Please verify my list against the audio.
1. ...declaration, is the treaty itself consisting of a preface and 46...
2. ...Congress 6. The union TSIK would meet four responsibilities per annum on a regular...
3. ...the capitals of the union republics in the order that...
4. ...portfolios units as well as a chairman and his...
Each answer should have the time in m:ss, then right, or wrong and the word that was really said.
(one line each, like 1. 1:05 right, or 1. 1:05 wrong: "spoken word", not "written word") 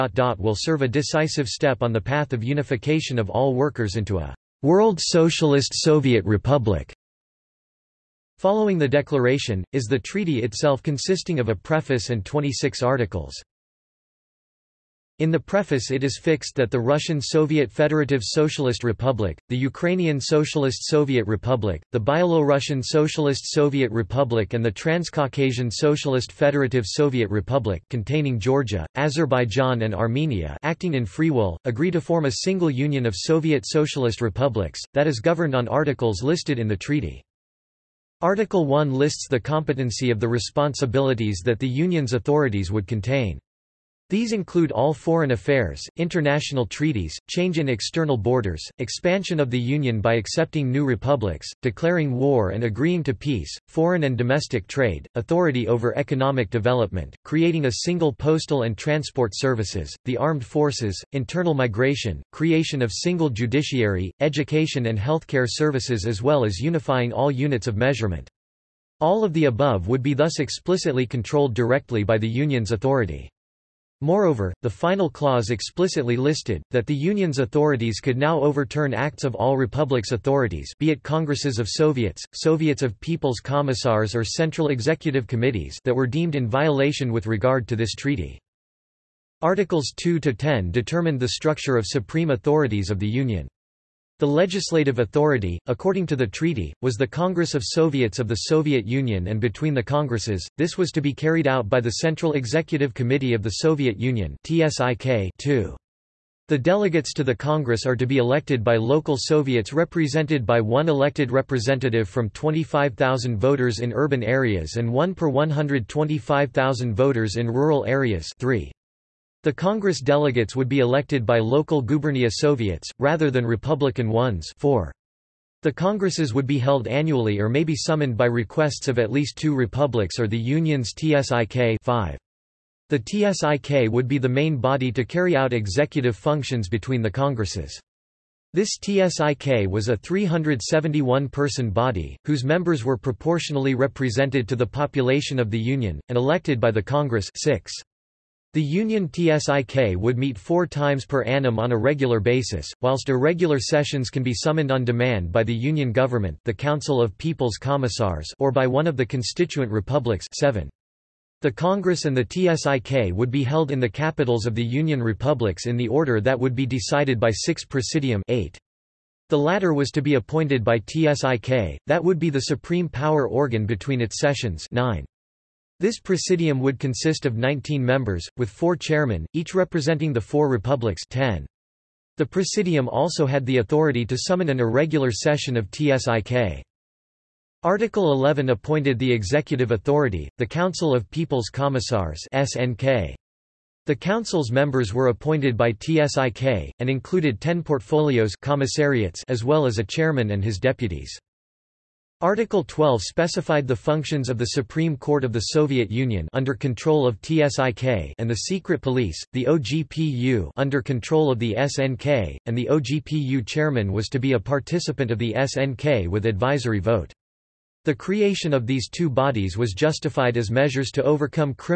1. 0:08 wrong: "26", not "46"
2. 2:26 wrong: "times", not "responsibilities"
3. 2:43 right
4. 3:17 wrong: "commissariats", not "units".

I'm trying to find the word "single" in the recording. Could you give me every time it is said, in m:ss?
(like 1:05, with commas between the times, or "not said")
0:32, 0:57, 1:02.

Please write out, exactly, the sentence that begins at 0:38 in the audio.
Article 1 lists the competency of the responsibilities that the Union's authorities would contain.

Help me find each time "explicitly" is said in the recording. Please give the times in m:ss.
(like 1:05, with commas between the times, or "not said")
1:10, 1:15.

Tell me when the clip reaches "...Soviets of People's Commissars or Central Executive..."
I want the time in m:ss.
1:22.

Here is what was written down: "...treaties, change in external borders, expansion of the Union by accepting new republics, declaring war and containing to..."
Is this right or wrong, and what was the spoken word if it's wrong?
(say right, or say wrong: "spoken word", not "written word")
wrong: "agreeing", not "containing".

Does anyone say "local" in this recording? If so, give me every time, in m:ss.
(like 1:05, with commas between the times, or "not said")
1:48, 2:01.